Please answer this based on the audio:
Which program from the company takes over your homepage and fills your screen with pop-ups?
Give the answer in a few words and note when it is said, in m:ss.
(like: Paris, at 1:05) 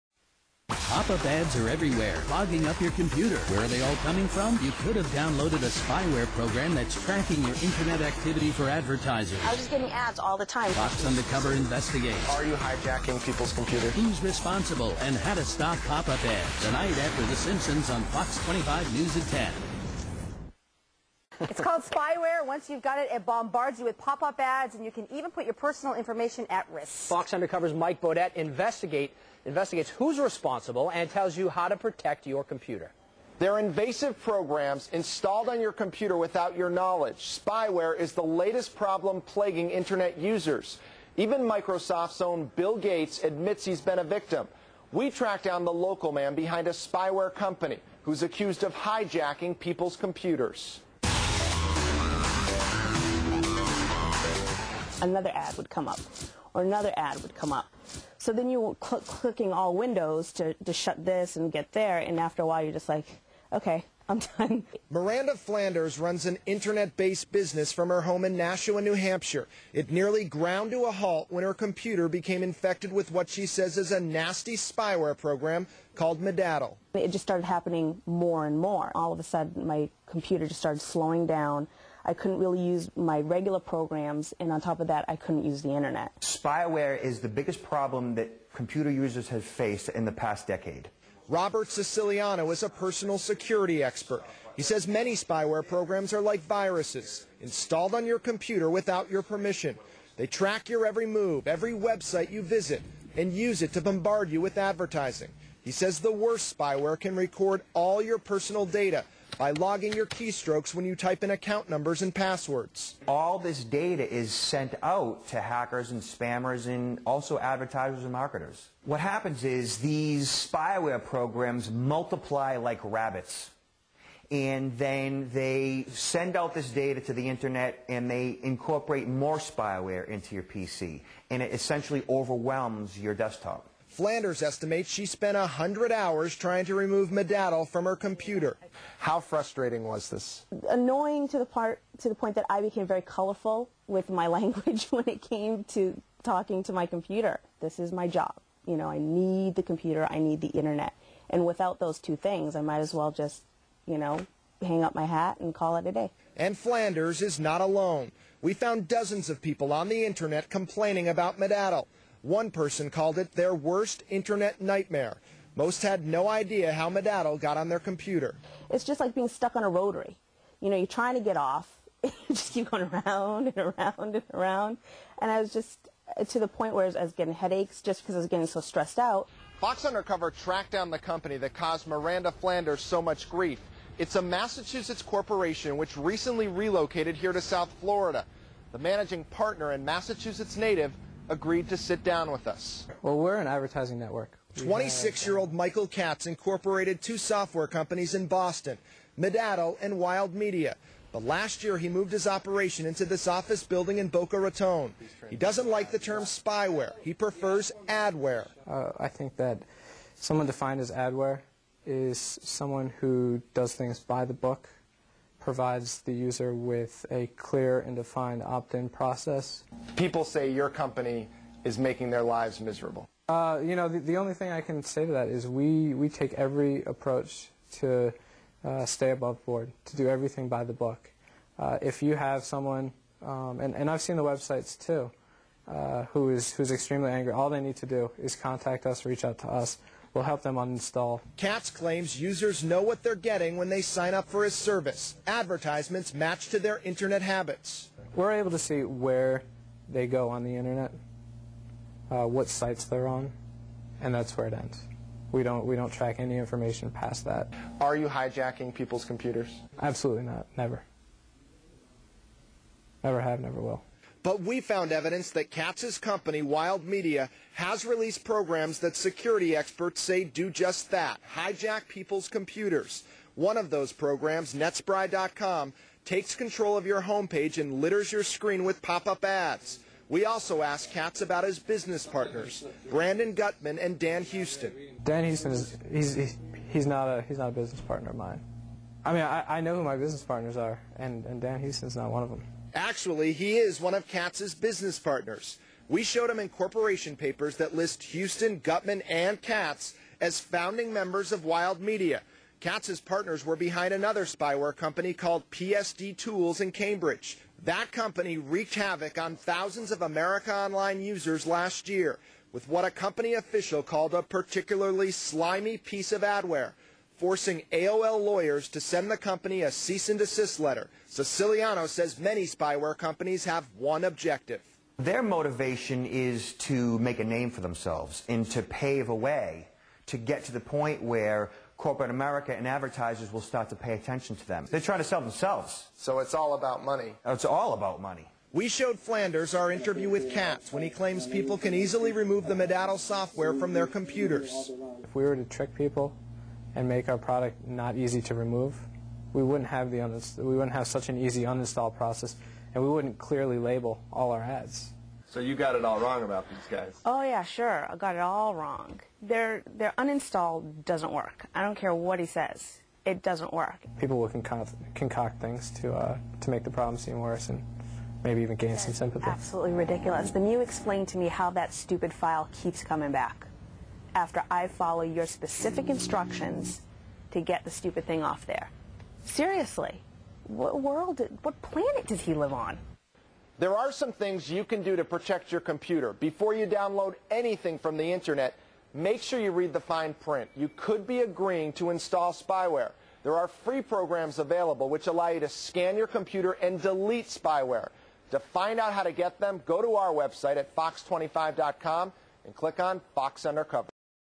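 netspry.com, at 4:34.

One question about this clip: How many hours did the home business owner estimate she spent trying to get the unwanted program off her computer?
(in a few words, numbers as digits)
100.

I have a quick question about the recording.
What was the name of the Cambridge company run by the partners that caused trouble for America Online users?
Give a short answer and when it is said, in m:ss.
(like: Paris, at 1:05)
PSD Tools, at 5:05.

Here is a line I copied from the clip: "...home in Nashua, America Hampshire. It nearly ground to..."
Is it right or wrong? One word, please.
wrong.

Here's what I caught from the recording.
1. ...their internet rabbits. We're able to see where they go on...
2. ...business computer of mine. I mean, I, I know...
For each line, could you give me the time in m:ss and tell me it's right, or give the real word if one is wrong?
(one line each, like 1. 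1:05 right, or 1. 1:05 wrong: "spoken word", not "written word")
1. 4:06 wrong: "habits", not "rabbits"
2. 4:47 wrong: "partner", not "computer".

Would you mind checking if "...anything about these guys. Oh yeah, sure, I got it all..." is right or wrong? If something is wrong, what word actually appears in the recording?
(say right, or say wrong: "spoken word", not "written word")
wrong: "wrong", not "anything".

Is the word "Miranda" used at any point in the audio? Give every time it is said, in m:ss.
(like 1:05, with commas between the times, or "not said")
1:04, 3:01.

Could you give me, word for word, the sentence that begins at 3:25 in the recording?
He doesn't like the term spyware.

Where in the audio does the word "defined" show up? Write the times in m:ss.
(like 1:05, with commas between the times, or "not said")
3:30, 3:37.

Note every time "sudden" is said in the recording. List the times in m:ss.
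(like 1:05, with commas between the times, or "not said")
1:19.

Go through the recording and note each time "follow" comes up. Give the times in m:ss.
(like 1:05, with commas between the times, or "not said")
6:14.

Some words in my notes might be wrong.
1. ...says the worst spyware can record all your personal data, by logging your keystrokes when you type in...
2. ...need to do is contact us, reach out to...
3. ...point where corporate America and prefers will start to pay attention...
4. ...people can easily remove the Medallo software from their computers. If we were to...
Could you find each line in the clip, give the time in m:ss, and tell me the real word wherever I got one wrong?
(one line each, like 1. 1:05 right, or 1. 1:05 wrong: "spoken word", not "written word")
1. 1:45 right
2. 3:57 right
3. 5:30 wrong: "advertisers", not "prefers"
4. 5:41 right.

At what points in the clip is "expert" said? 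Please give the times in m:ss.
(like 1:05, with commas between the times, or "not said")
1:33, 4:29.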